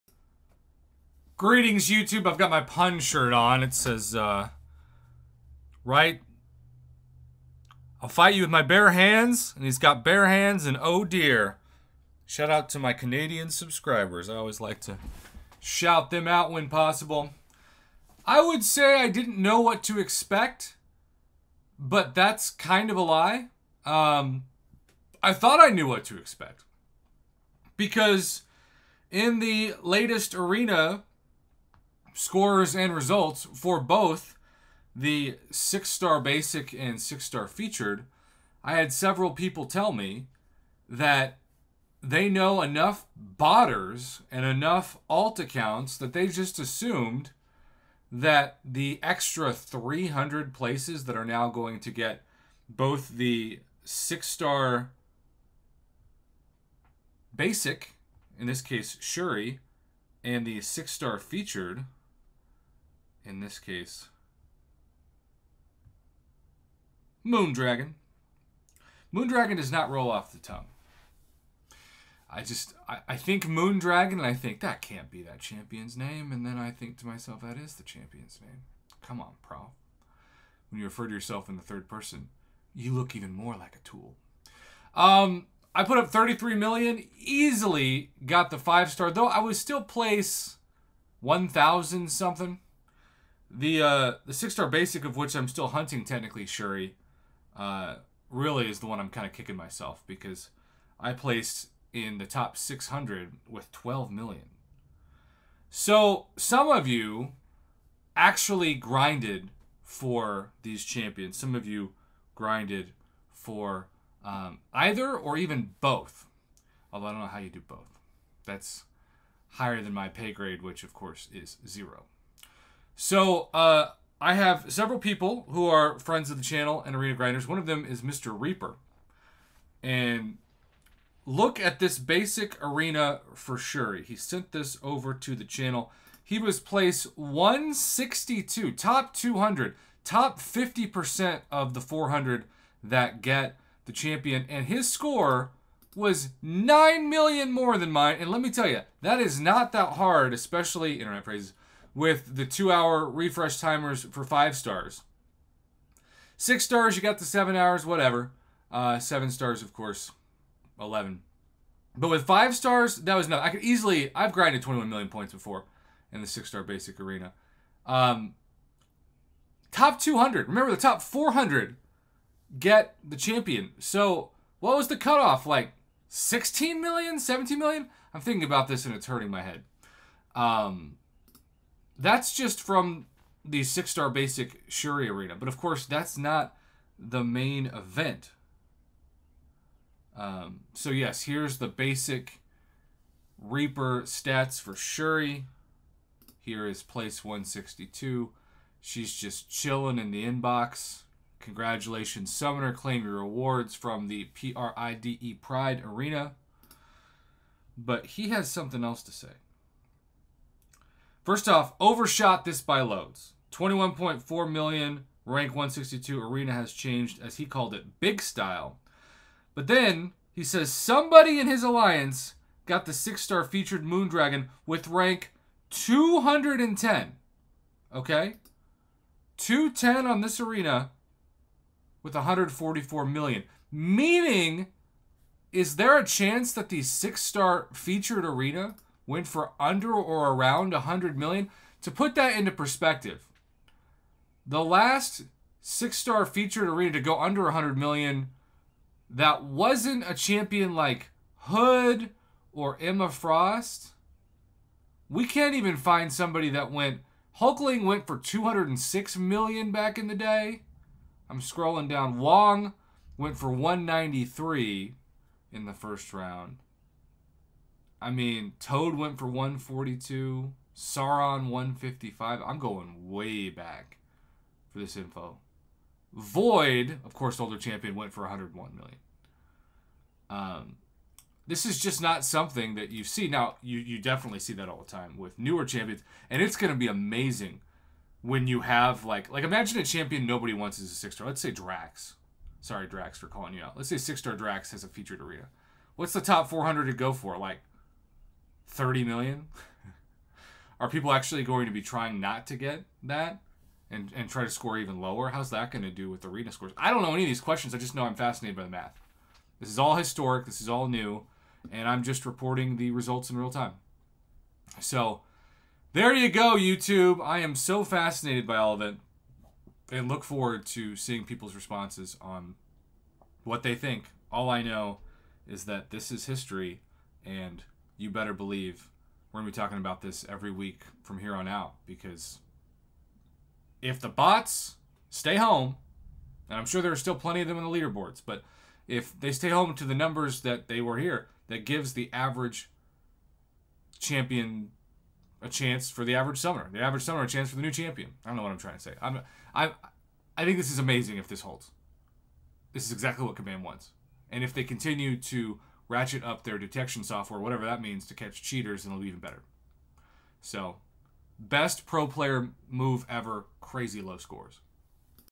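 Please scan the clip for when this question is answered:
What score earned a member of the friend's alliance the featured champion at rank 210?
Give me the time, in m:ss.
3:52.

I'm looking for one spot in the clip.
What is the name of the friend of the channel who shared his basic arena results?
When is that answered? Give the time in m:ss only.
2:08.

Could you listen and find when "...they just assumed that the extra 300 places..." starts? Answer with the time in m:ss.
0:46.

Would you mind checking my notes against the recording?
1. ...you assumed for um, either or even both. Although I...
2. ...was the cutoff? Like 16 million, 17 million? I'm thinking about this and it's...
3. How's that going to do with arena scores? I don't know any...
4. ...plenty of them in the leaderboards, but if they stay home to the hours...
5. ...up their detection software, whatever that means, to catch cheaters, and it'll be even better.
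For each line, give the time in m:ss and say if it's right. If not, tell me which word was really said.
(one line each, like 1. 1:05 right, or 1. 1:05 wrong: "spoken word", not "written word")
1. 1:51 wrong: "grinded", not "assumed"
2. 2:54 right
3. 5:05 right
4. 5:37 wrong: "numbers", not "hours"
5. 5:56 right.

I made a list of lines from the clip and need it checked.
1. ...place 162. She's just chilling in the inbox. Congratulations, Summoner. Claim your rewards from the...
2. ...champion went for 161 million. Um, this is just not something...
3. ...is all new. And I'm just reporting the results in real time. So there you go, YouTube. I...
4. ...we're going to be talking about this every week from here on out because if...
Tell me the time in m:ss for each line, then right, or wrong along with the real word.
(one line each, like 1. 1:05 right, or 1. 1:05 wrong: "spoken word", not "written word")
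1. 3:16 right
2. 4:37 wrong: "101", not "161"
3. 5:10 right
4. 5:29 right.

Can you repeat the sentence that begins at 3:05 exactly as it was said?
But of course, that's not the main event.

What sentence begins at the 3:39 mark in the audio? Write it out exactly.
But then he says somebody in his alliance got the six star featured Moondragon with rank 210.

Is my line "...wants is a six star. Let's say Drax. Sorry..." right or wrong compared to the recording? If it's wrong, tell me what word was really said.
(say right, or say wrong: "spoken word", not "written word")
right.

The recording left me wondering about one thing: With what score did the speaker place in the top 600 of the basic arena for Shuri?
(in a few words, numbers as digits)
12 million.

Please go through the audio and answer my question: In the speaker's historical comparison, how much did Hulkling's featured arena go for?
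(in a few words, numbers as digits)
206 million.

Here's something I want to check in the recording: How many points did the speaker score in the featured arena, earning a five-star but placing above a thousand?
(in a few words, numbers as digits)
33 million.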